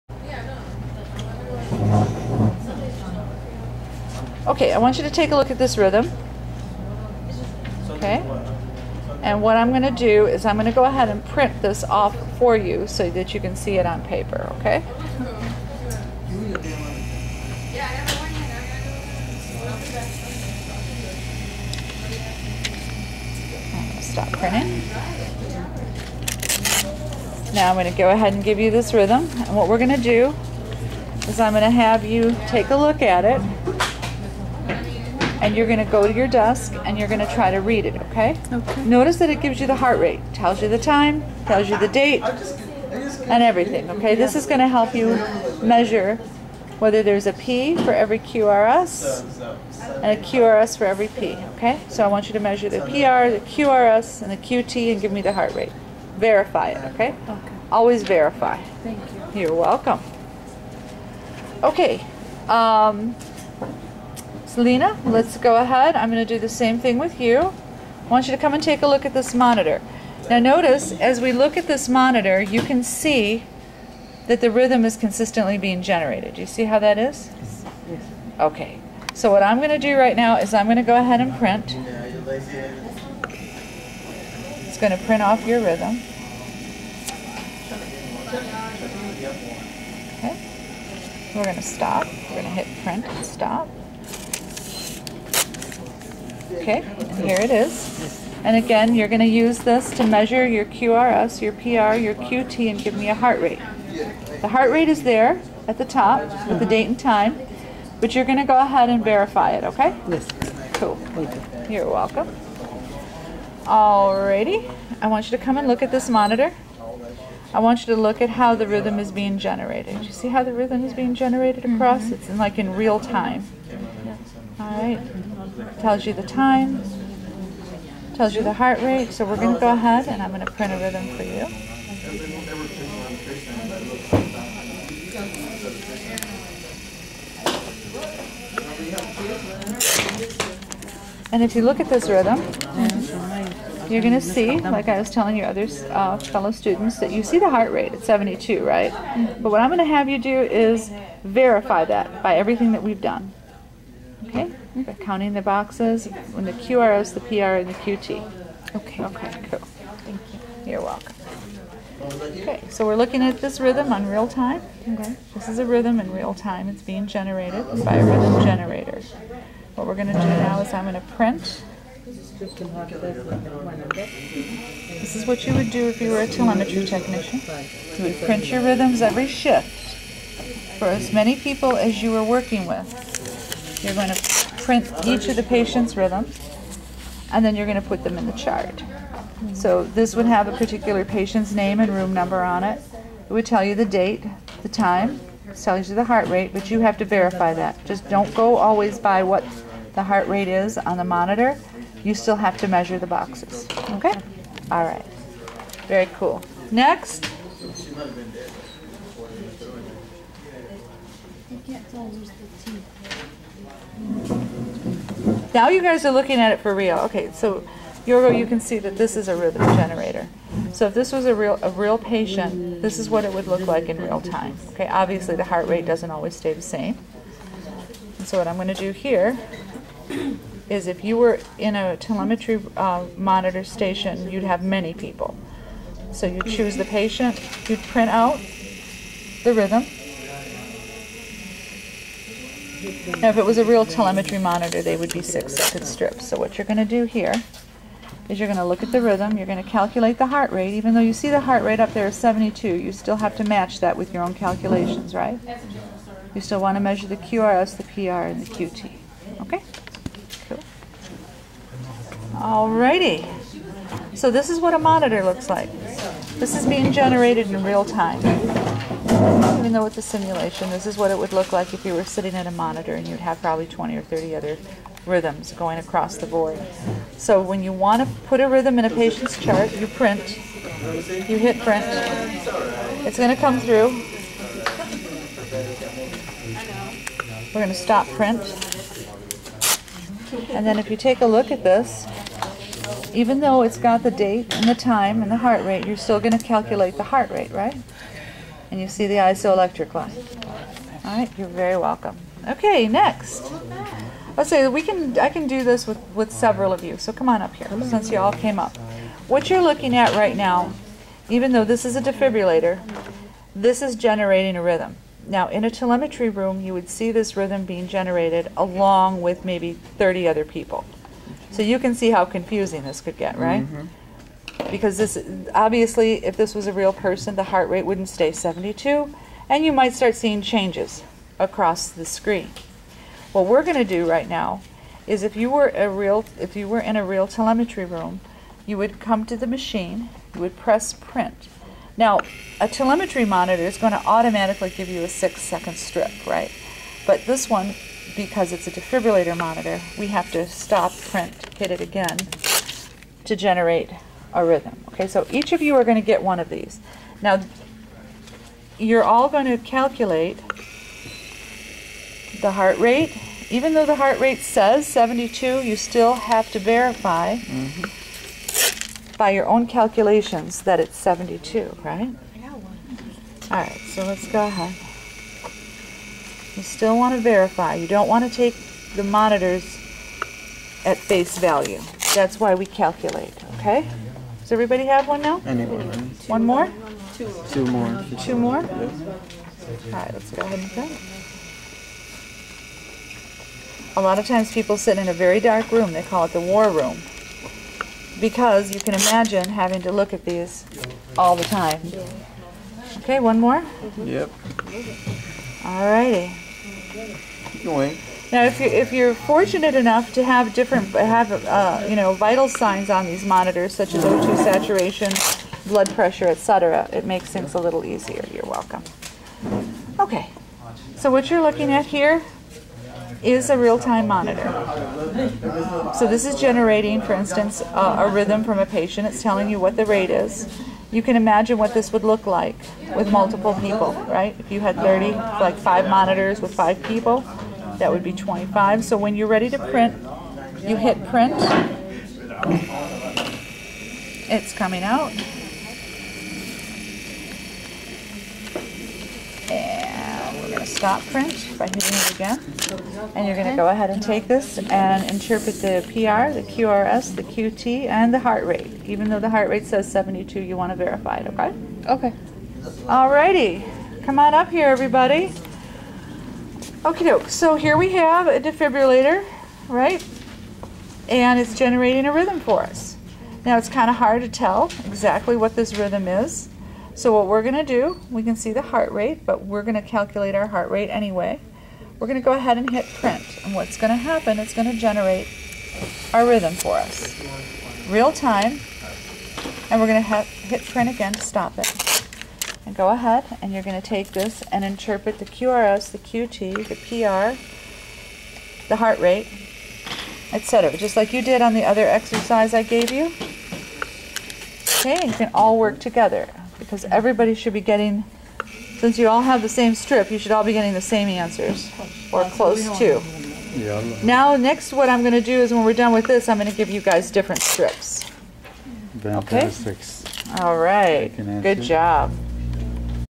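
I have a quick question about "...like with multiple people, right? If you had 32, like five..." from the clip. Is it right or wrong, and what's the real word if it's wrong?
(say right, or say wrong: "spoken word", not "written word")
wrong: "30", not "32".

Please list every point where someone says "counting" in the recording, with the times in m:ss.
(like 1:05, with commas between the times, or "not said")
2:34.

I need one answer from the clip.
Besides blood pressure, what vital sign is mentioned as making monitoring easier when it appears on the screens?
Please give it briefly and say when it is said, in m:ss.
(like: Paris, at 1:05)
O2 saturation, at 6:54.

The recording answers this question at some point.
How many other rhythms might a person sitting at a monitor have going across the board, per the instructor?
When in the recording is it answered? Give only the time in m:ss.
4:33.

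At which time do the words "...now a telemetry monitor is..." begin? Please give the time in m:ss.
5:41.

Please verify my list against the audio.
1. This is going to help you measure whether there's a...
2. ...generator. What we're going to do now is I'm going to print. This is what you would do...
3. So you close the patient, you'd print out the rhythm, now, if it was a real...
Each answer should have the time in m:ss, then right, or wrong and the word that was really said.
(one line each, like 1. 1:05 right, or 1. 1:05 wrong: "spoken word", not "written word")
1. 0:44 right
2. 2:48 right
3. 3:56 wrong: "choose", not "close".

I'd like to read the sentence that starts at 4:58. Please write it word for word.
and you see the isoelectric line.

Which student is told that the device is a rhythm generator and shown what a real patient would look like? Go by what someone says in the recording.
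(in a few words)
Yorgo.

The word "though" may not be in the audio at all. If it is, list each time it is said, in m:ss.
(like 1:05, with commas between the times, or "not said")
4:10, 4:29, 4:53, 5:11, 6:03, 7:39.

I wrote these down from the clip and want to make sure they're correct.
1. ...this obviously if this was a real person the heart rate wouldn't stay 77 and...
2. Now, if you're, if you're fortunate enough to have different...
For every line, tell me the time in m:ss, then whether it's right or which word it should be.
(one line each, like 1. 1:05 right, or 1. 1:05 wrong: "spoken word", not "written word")
1. 5:24 wrong: "72", not "77"
2. 6:48 right.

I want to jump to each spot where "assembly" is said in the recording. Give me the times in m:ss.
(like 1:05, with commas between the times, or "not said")
not said.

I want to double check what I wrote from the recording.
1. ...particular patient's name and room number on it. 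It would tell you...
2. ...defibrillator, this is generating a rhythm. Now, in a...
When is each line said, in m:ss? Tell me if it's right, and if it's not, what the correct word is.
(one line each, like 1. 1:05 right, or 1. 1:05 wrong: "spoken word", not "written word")
1. 3:10 right
2. 5:12 right.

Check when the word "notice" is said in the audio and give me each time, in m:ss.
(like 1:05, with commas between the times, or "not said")
0:38, 1:10.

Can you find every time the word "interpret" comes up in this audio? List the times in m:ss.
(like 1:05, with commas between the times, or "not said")
7:35, 8:14.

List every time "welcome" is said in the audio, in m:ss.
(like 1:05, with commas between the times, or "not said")
0:59, 1:51, 2:40, 5:01, 6:58.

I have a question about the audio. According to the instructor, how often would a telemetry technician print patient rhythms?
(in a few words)
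every shift.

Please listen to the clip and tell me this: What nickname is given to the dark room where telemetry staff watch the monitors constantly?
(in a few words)
the war room.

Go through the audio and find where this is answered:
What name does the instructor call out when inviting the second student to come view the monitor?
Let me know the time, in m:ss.
1:04.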